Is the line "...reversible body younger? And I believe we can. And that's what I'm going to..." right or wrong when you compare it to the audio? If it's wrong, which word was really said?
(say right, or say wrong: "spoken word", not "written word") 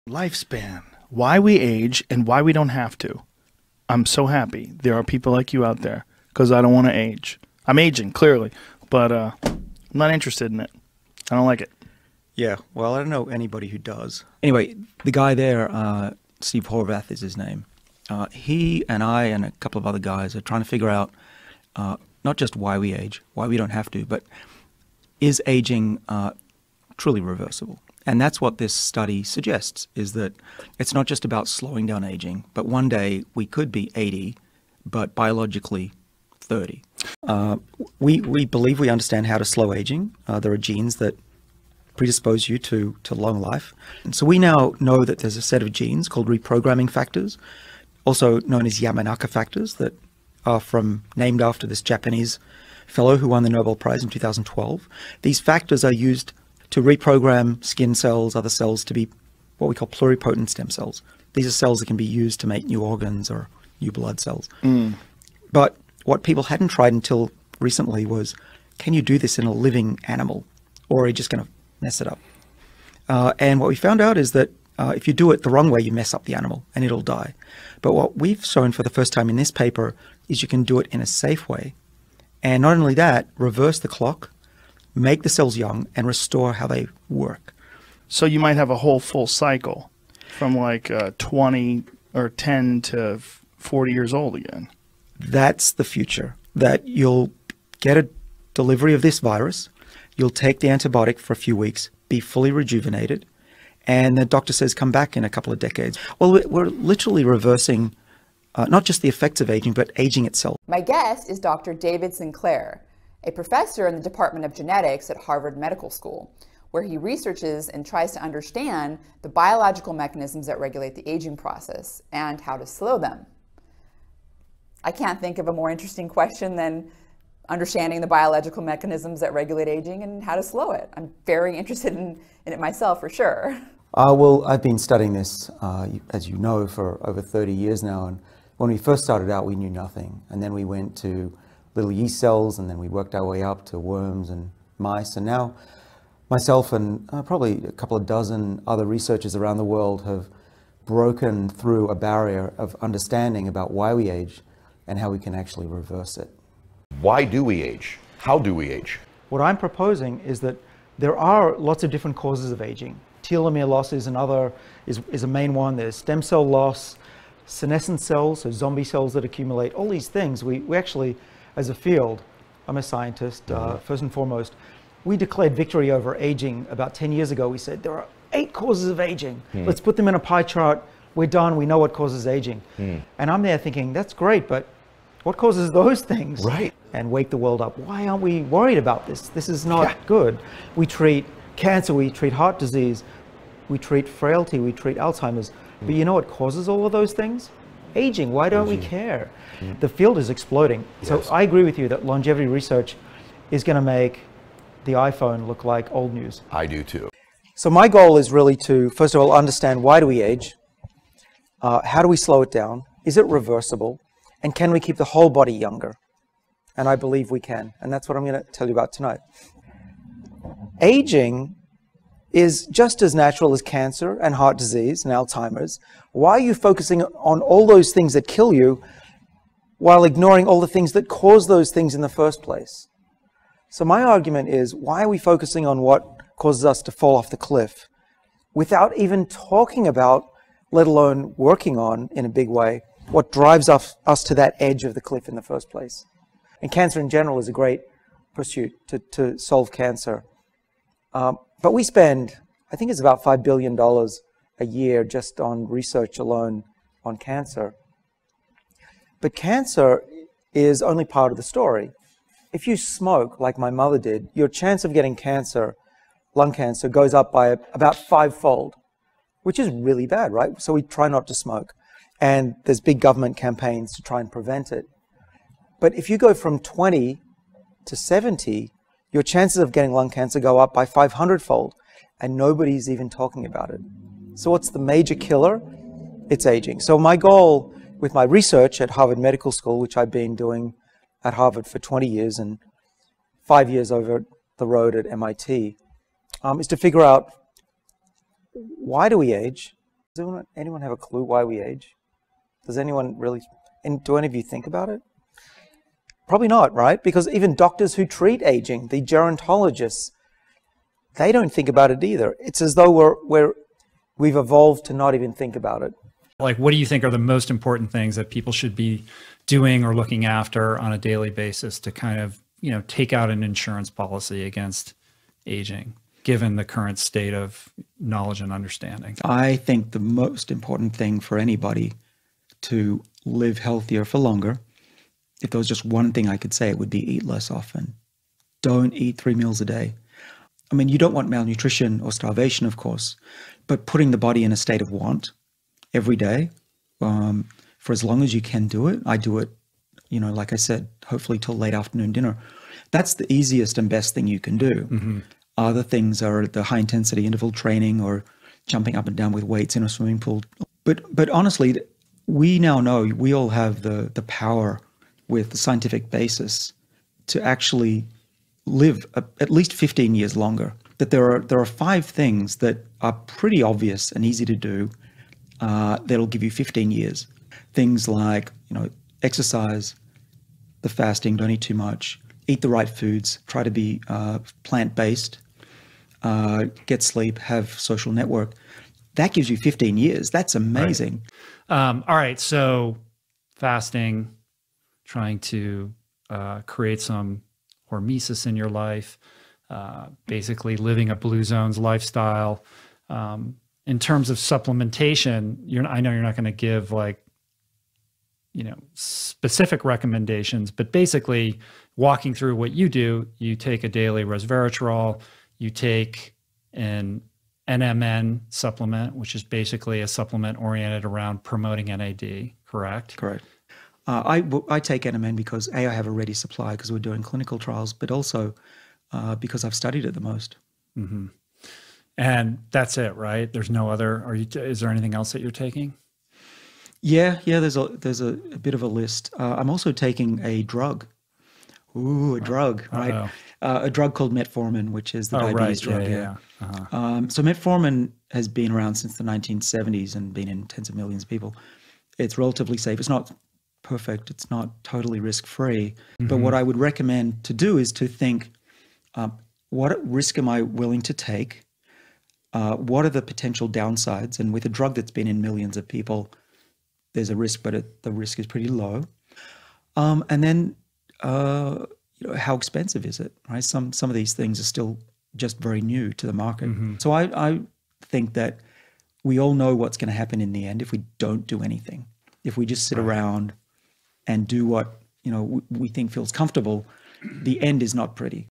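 wrong: "whole", not "reversible".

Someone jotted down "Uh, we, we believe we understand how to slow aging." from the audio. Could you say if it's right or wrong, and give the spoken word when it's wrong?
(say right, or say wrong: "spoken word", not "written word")
right.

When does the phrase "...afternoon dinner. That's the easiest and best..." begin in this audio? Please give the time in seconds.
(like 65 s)
351 s.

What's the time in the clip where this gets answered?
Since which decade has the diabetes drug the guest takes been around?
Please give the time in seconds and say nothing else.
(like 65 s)
449 s.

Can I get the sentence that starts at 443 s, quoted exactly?
Uh, a drug called metformin, which is the oh, diabetes right.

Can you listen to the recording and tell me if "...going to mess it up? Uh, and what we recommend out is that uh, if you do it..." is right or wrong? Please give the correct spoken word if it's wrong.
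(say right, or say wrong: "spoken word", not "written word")
wrong: "found", not "recommend".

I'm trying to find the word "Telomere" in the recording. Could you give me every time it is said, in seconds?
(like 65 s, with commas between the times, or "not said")
163 s.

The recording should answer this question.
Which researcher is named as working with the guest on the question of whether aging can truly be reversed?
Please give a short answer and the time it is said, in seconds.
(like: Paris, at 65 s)
Steve Horvath, at 16 s.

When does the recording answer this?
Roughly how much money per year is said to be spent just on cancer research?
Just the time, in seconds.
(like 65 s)
253 s.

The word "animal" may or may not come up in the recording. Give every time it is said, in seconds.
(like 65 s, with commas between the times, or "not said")
70 s, 76 s.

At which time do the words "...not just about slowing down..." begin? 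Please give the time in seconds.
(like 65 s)
30 s.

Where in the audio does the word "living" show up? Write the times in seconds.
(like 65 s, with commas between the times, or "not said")
69 s, 400 s.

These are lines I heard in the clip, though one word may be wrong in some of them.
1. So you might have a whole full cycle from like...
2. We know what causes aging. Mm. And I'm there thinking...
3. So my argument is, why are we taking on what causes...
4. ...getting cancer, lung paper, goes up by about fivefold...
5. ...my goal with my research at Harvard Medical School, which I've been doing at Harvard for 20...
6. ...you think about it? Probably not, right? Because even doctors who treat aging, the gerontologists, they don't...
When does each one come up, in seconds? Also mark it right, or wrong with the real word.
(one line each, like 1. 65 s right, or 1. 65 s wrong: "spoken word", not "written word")
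1. 88 s right
2. 181 s right
3. 233 s wrong: "focusing", not "taking"
4. 264 s wrong: "cancer", not "paper"
5. 286 s right
6. 304 s right.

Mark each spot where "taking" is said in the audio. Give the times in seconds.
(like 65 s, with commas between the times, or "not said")
435 s, 439 s.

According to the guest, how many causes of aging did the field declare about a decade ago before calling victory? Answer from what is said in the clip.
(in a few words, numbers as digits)
8.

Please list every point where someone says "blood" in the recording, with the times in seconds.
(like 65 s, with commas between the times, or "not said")
63 s.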